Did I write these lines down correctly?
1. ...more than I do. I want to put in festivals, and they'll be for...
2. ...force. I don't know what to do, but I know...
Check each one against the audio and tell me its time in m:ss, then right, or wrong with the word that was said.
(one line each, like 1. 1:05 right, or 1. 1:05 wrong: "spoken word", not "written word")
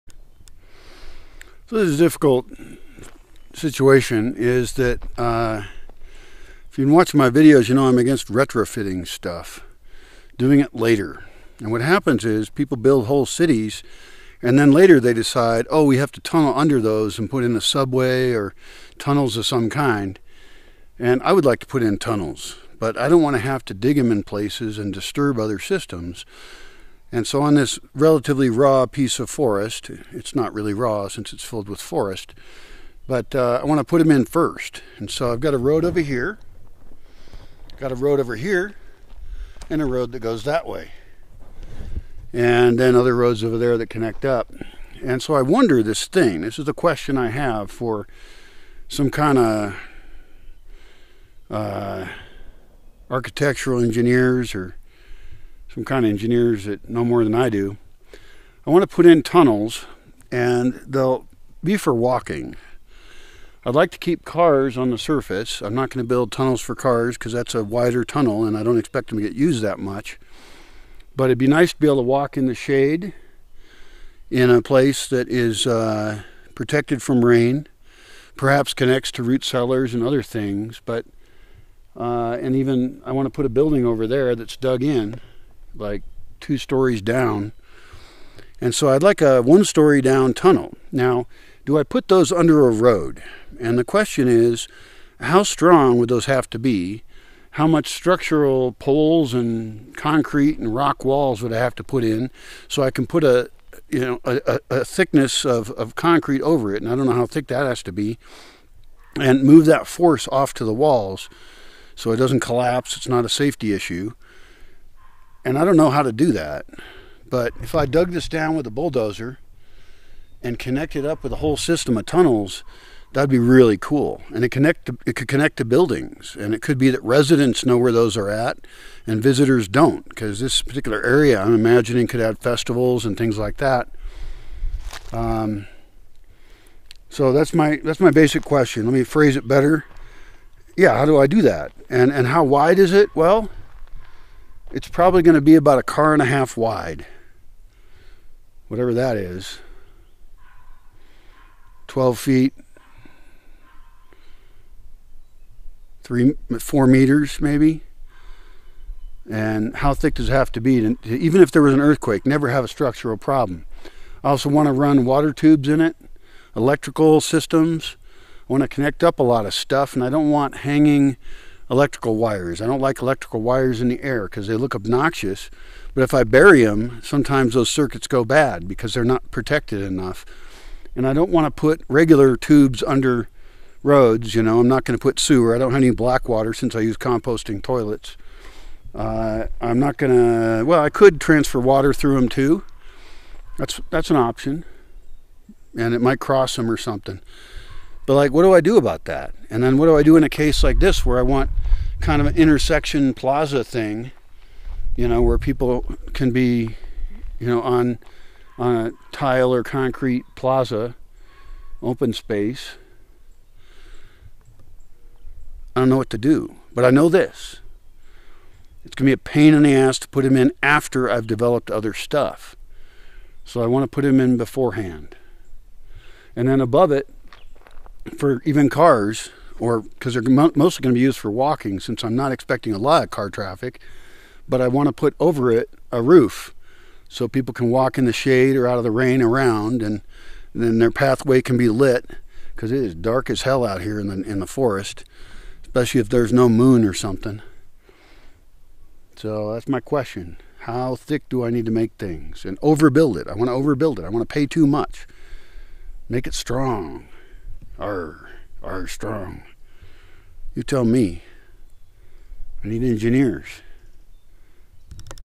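1. 0:57 wrong: "tunnels", not "festivals"
2. 3:32 wrong: "space", not "force".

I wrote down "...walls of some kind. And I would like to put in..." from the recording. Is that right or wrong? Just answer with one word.
wrong.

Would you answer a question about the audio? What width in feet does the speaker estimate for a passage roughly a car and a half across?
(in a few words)
12 feet.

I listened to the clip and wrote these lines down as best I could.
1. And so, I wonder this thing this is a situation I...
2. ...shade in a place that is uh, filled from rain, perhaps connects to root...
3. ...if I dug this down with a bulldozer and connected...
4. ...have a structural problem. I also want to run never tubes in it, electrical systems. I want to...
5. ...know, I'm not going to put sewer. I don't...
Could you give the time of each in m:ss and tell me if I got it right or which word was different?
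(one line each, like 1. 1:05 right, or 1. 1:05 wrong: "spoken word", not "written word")
1. 0:45 wrong: "question", not "situation"
2. 1:12 wrong: "protected", not "filled"
3. 1:57 right
4. 2:42 wrong: "water", not "never"
5. 3:04 right.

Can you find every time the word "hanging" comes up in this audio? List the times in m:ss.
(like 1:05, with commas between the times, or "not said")
2:50.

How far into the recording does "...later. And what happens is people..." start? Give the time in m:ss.
0:10.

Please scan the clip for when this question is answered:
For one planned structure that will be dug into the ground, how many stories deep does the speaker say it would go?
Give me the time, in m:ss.
1:26.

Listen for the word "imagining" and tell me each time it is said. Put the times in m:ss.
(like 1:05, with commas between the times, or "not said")
2:11.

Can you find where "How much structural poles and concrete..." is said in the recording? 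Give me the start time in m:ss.
1:37.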